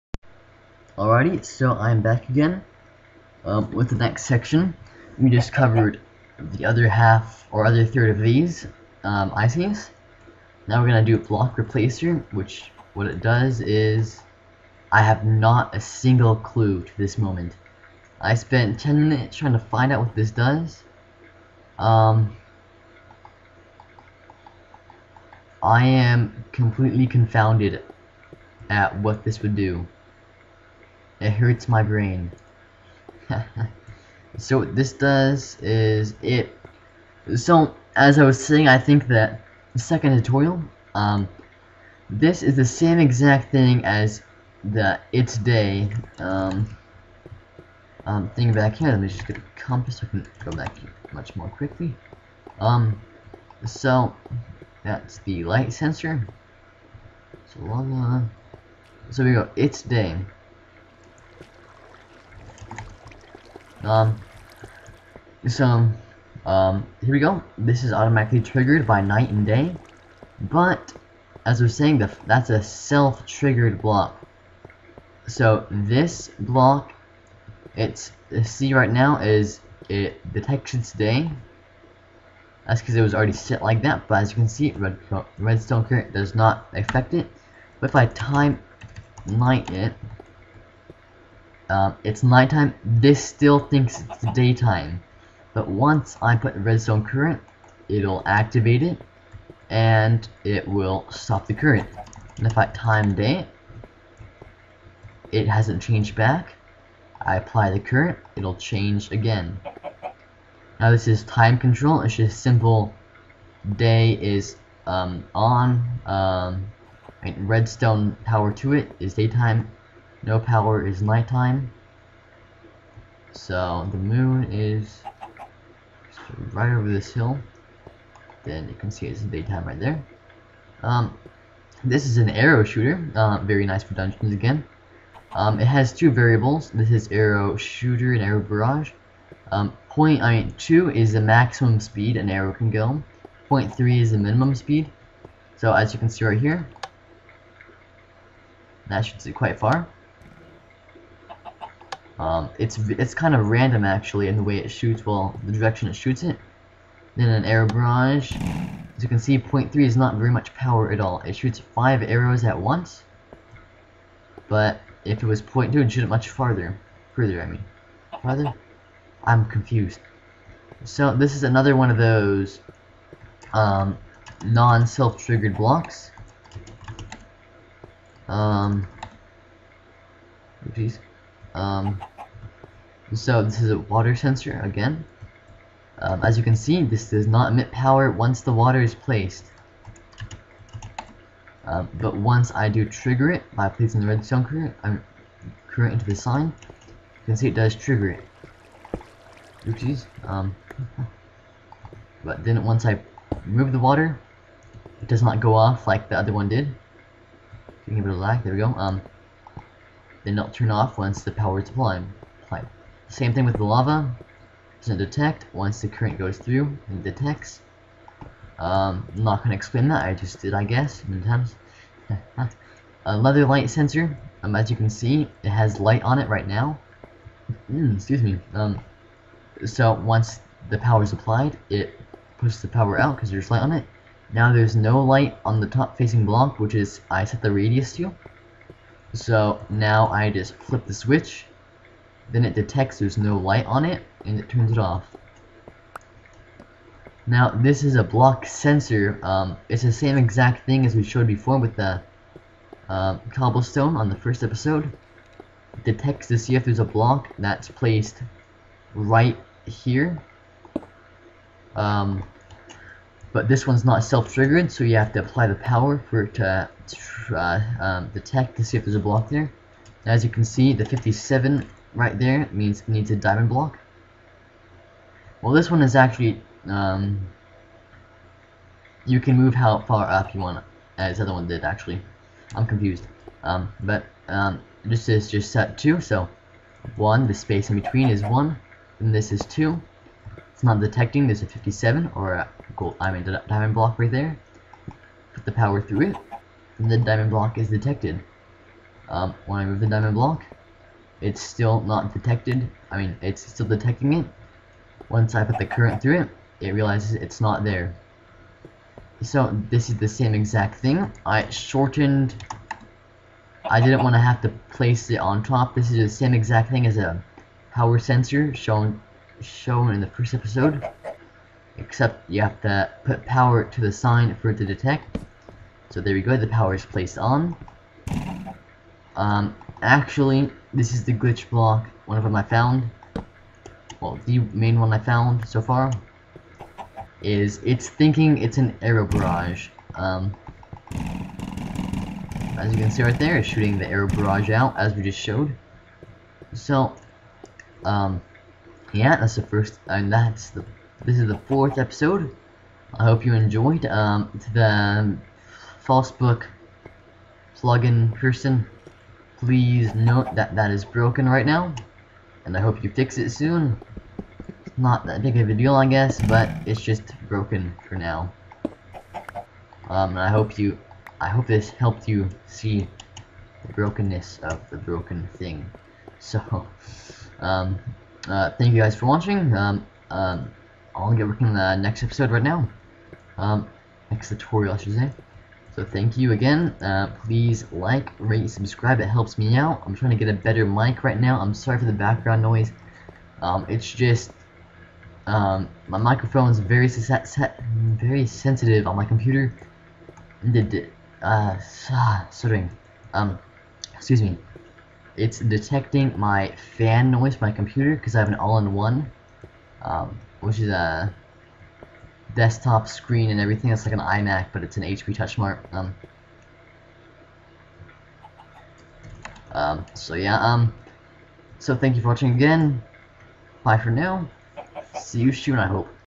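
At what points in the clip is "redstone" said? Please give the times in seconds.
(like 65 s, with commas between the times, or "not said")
85 s, 96 s, 117 s, 194 s.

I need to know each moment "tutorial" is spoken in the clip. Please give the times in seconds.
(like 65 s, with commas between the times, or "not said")
40 s, 384 s.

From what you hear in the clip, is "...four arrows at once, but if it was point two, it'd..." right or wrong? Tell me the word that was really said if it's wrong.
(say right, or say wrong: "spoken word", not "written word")
wrong: "five", not "four".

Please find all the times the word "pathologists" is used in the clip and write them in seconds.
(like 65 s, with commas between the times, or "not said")
not said.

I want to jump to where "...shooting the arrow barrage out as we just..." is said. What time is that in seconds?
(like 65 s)
343 s.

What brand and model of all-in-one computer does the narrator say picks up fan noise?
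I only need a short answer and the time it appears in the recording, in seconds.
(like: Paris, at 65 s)
HP TouchSmart, at 414 s.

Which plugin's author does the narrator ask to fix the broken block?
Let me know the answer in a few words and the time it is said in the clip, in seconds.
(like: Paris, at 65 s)
FalseBook, at 355 s.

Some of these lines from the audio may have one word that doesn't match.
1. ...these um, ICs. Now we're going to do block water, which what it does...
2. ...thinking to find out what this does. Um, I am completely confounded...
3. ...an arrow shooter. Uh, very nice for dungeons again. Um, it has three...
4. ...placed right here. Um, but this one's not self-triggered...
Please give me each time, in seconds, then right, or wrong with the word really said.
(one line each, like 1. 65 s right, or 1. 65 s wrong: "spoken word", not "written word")
1. 8 s wrong: "replacer", not "water"
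2. 19 s wrong: "trying", not "thinking"
3. 132 s wrong: "two", not "three"
4. 257 s right.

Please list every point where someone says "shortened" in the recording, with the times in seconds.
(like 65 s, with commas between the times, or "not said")
311 s.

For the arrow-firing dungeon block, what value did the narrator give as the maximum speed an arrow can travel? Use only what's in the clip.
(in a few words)
0.2.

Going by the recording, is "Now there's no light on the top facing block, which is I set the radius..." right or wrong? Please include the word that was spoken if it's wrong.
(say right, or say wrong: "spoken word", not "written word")
right.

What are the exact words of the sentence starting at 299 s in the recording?
Um, when I move the diamond block, it's still not detected.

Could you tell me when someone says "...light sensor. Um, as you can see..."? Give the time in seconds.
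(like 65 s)
223 s.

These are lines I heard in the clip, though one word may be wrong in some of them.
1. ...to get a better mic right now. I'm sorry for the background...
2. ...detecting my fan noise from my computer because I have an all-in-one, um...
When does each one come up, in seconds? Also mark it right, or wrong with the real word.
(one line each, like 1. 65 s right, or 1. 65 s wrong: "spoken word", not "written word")
1. 390 s right
2. 405 s right.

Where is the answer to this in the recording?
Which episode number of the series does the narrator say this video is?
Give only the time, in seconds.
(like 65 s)
351 s.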